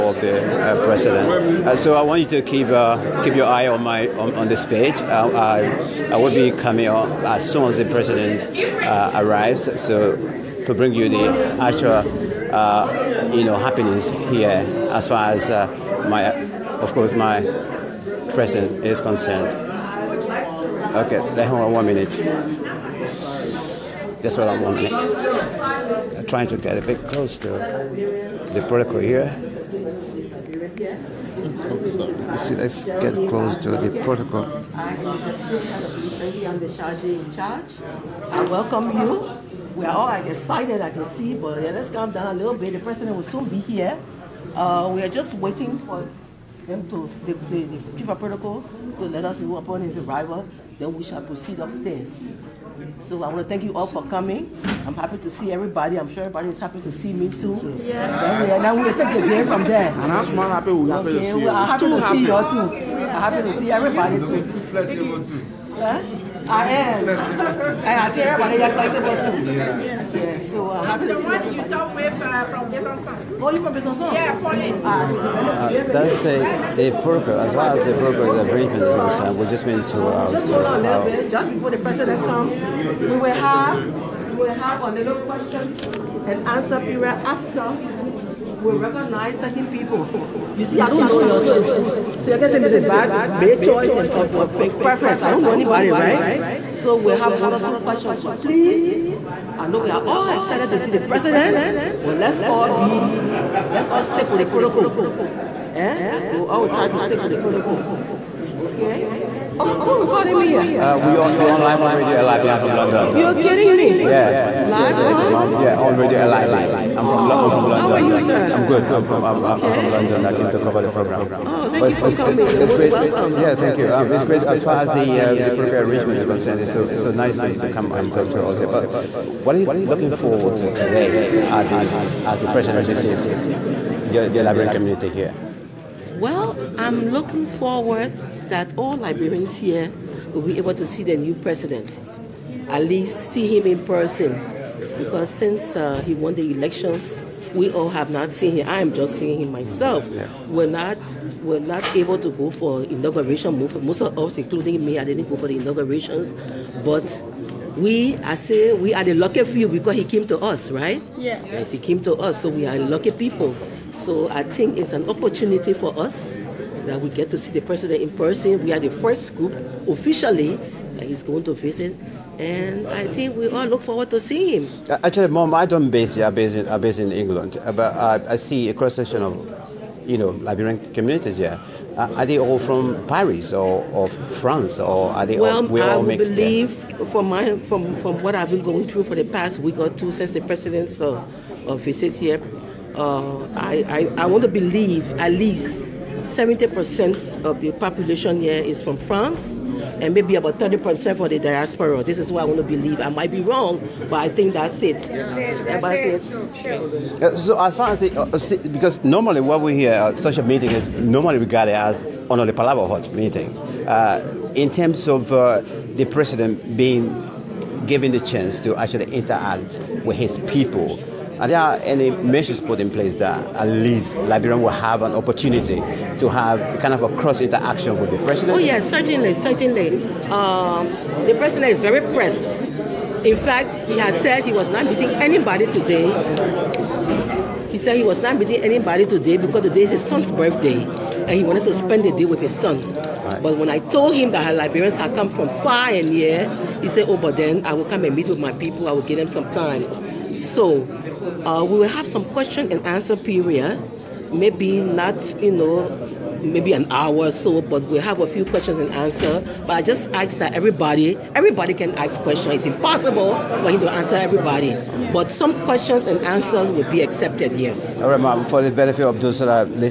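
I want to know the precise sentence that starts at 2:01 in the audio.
Oh, thank but you for coming.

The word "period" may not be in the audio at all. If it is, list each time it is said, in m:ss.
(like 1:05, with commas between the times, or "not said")
1:26, 4:13.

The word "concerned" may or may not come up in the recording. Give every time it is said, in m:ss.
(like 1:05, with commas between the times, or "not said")
0:18, 1:18, 2:06.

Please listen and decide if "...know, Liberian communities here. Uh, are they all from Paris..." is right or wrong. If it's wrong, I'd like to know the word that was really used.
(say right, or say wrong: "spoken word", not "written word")
right.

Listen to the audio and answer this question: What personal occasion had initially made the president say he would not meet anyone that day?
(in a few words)
His son's birthday.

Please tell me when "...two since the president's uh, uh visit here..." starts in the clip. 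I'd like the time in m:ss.
3:09.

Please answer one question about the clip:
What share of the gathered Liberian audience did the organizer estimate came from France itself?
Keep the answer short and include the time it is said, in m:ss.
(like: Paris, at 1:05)
70%, at 3:16.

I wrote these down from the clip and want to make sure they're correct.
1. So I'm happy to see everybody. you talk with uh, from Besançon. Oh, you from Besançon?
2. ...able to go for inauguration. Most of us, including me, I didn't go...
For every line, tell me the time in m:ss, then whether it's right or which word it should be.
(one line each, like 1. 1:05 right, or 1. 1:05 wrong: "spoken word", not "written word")
1. 1:10 right
2. 2:31 right.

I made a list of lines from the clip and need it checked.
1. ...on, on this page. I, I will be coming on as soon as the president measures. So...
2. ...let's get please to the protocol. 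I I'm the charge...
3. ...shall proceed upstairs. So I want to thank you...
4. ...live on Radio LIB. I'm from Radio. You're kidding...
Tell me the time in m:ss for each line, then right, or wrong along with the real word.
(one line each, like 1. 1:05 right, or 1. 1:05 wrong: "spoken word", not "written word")
1. 0:04 wrong: "arrives", not "measures"
2. 0:32 wrong: "close", not "please"
3. 0:51 right
4. 1:51 wrong: "London", not "Radio".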